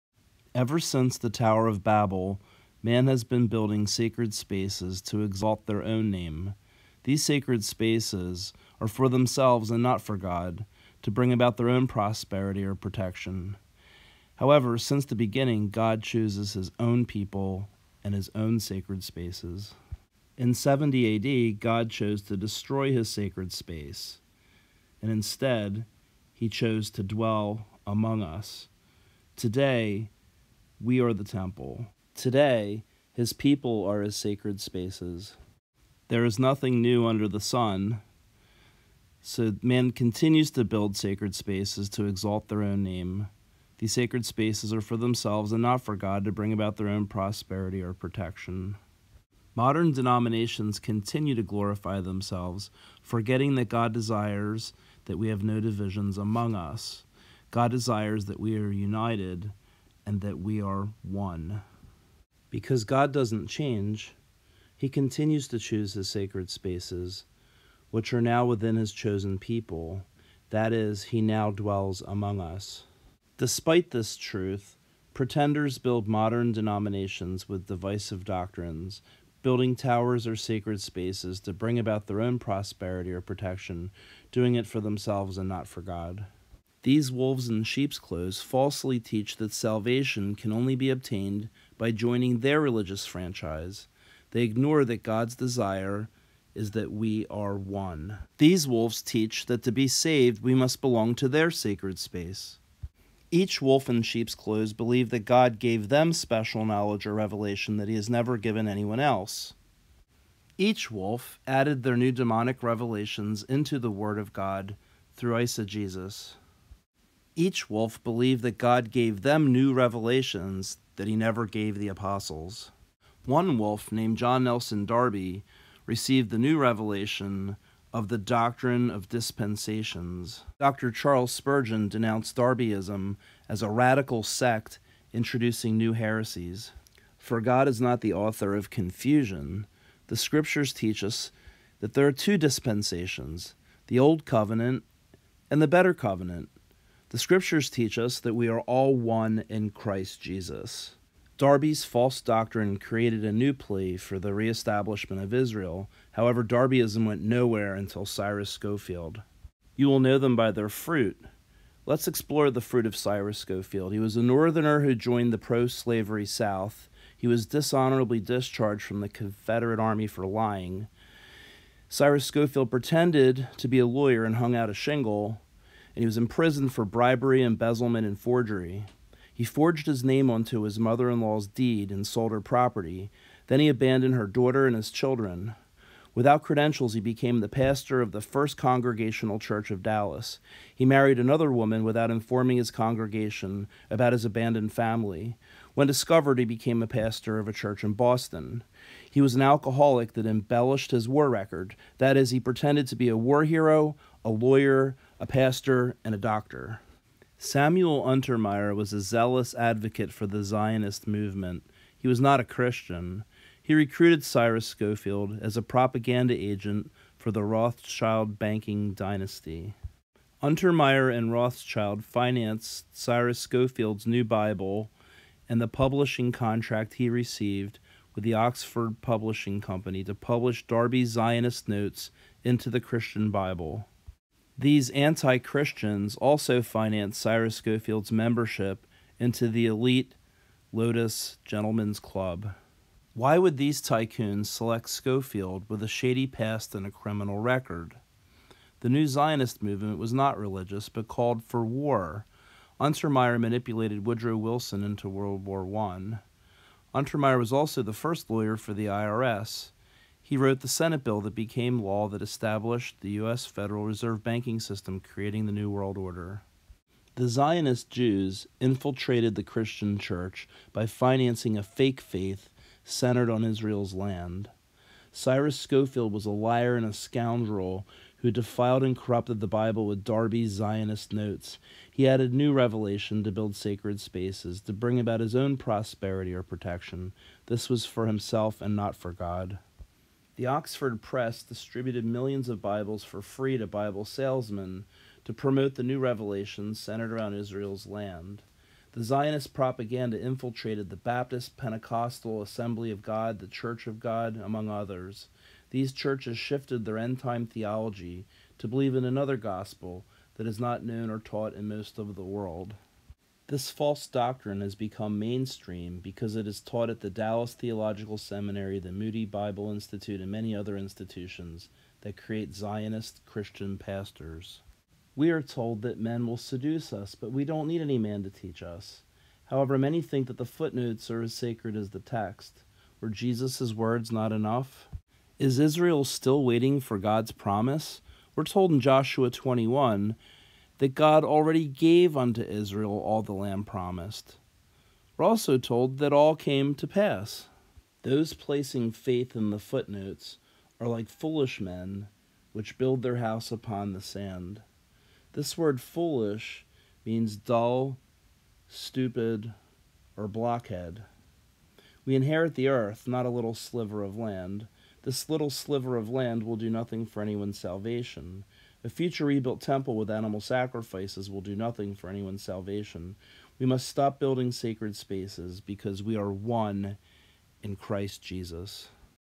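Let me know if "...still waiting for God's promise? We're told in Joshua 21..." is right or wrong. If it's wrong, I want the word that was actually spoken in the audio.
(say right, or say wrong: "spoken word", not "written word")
right.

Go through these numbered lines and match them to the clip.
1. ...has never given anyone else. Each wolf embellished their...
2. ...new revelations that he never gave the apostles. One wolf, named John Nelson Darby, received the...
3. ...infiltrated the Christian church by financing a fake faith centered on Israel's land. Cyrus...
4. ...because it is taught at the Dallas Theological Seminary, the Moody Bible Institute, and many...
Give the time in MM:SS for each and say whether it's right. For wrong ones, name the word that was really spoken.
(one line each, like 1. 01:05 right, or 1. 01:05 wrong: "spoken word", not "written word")
1. 01:47 wrong: "added", not "embellished"
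2. 01:59 right
3. 04:28 right
4. 05:16 right.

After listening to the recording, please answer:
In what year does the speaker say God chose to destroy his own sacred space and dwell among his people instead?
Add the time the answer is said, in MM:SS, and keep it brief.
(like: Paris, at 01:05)
70 AD, at 00:20.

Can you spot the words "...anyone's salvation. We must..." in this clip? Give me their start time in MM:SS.
06:12.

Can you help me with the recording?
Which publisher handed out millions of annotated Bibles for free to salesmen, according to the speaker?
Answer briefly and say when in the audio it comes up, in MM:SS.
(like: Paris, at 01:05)
Oxford Press, at 04:50.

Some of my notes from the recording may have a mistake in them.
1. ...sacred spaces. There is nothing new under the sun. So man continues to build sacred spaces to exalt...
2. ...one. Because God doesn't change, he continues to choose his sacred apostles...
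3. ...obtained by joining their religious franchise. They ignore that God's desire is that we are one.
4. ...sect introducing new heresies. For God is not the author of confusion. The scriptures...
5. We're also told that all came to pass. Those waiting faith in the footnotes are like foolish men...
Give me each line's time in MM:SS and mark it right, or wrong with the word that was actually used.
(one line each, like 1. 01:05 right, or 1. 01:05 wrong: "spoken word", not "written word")
1. 00:34 right
2. 01:01 wrong: "spaces", not "apostles"
3. 01:30 right
4. 02:14 right
5. 05:45 wrong: "placing", not "waiting".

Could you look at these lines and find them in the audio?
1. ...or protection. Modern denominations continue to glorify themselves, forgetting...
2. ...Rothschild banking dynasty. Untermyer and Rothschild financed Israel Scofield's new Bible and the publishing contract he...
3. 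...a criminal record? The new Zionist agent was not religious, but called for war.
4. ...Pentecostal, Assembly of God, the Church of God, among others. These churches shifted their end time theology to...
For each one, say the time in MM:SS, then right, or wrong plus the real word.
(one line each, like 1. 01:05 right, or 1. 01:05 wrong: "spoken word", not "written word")
1. 00:47 right
2. 03:37 wrong: "Cyrus", not "Israel"
3. 04:06 wrong: "movement", not "agent"
4. 05:01 right.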